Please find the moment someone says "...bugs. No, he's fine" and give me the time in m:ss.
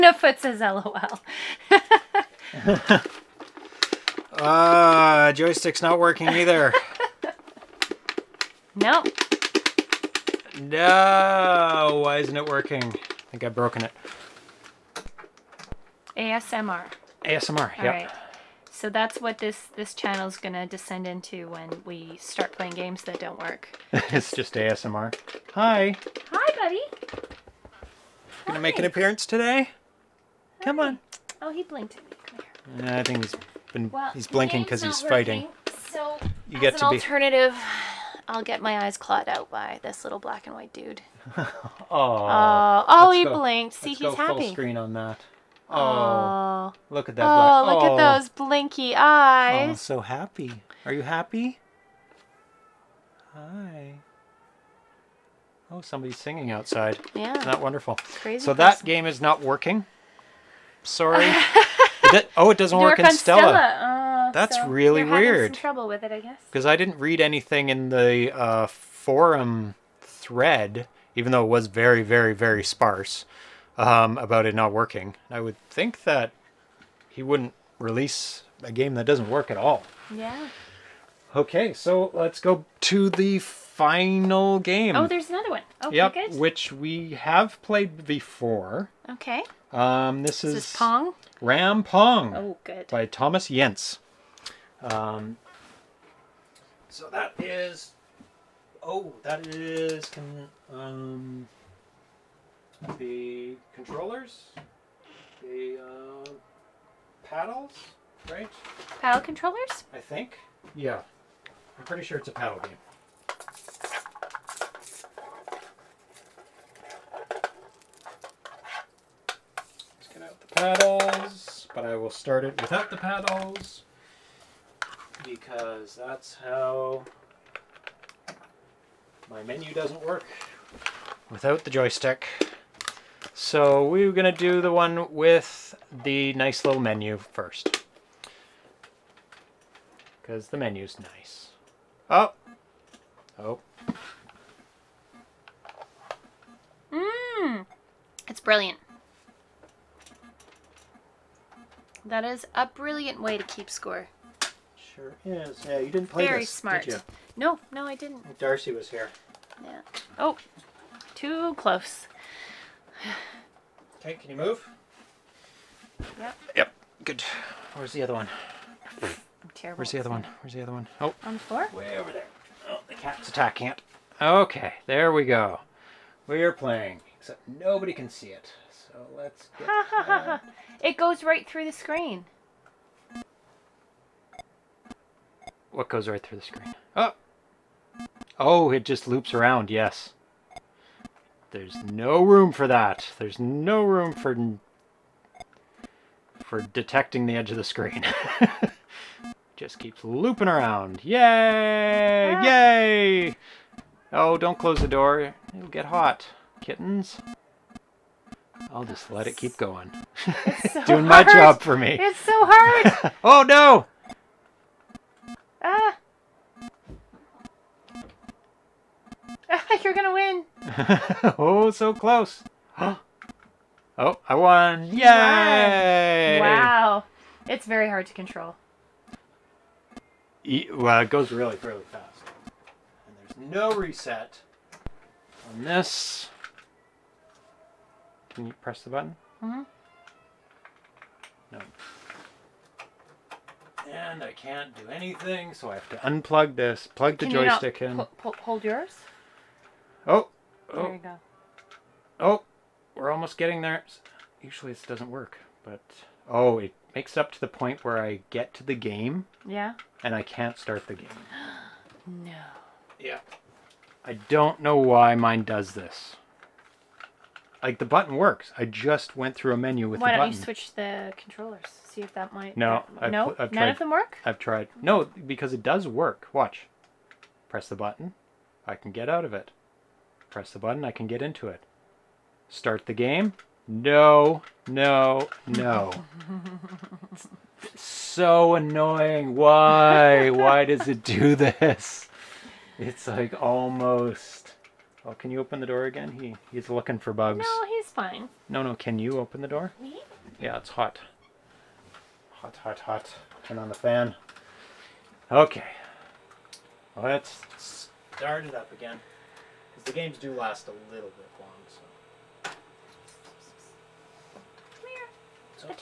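4:57.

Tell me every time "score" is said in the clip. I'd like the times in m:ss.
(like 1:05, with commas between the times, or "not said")
2:33.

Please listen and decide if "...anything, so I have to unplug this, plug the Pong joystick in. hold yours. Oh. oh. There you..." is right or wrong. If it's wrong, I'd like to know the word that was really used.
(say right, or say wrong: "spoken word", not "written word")
wrong: "Can", not "Pong".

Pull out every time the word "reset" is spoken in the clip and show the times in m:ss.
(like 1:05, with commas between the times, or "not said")
3:53.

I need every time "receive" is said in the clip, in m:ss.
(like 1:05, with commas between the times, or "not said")
not said.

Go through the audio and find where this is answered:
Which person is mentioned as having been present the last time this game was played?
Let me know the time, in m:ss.
2:38.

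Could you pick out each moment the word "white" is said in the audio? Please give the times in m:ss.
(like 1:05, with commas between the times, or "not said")
0:40.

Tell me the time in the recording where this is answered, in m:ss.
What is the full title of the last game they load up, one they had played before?
1:31.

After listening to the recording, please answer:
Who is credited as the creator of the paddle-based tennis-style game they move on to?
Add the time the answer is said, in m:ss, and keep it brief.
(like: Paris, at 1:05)
Thomas Jentzsch, at 1:33.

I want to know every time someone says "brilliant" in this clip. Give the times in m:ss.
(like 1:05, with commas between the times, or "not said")
2:28, 2:32.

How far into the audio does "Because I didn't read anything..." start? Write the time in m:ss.
1:06.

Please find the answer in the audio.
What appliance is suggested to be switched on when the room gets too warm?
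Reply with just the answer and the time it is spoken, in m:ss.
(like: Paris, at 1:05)
The fan, at 5:03.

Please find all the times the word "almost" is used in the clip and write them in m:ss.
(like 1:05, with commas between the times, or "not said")
4:13, 4:53.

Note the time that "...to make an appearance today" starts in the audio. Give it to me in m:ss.
0:28.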